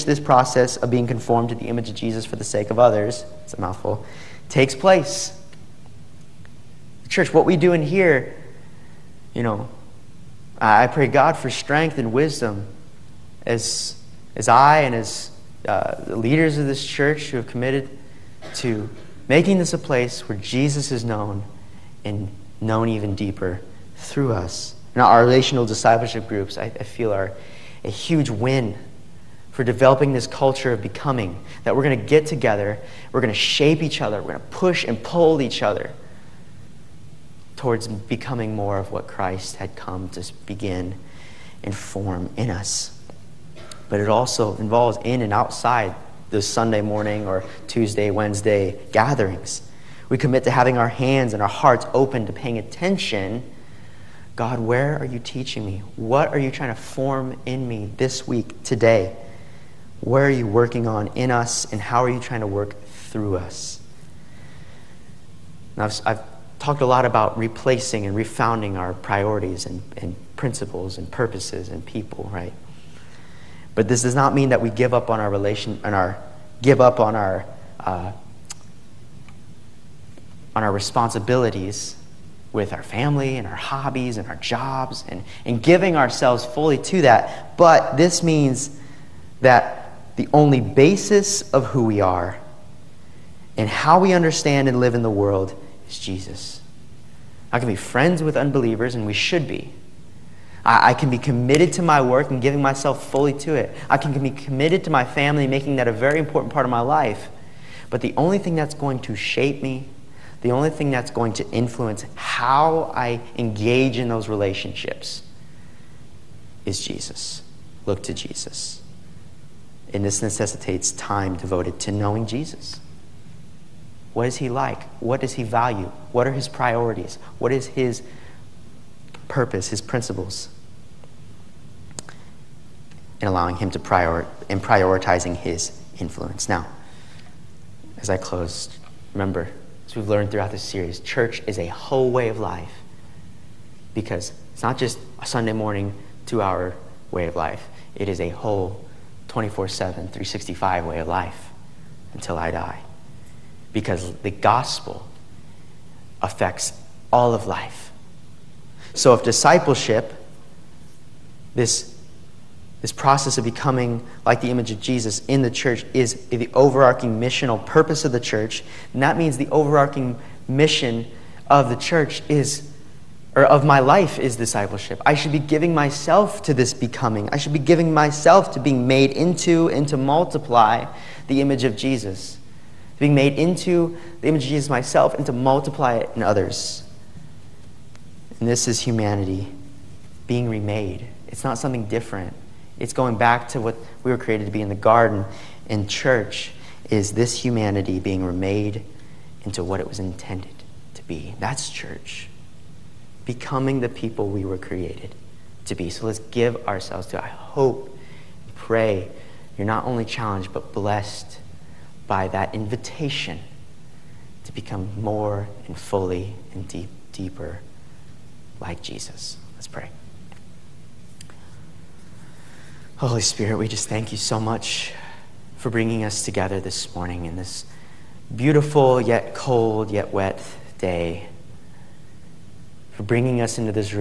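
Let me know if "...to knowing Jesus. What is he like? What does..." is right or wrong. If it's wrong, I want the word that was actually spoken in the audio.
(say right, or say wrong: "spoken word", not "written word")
right.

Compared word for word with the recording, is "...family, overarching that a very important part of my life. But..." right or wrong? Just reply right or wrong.
wrong.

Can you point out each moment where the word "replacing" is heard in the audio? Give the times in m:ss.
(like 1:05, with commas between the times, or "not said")
1:07.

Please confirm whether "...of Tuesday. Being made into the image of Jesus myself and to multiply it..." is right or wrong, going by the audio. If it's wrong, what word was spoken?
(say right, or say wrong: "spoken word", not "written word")
wrong: "Jesus", not "Tuesday".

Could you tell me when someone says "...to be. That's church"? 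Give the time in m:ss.
3:20.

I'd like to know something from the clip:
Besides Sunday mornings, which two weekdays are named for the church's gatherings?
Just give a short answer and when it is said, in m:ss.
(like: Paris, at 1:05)
Tuesday, Wednesday, at 0:47.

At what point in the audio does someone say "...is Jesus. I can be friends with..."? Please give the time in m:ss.
1:35.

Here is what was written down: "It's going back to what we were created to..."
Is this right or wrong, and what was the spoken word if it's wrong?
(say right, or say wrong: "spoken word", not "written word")
right.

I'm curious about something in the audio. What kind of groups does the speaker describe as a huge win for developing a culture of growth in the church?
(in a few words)
Relational discipleship groups.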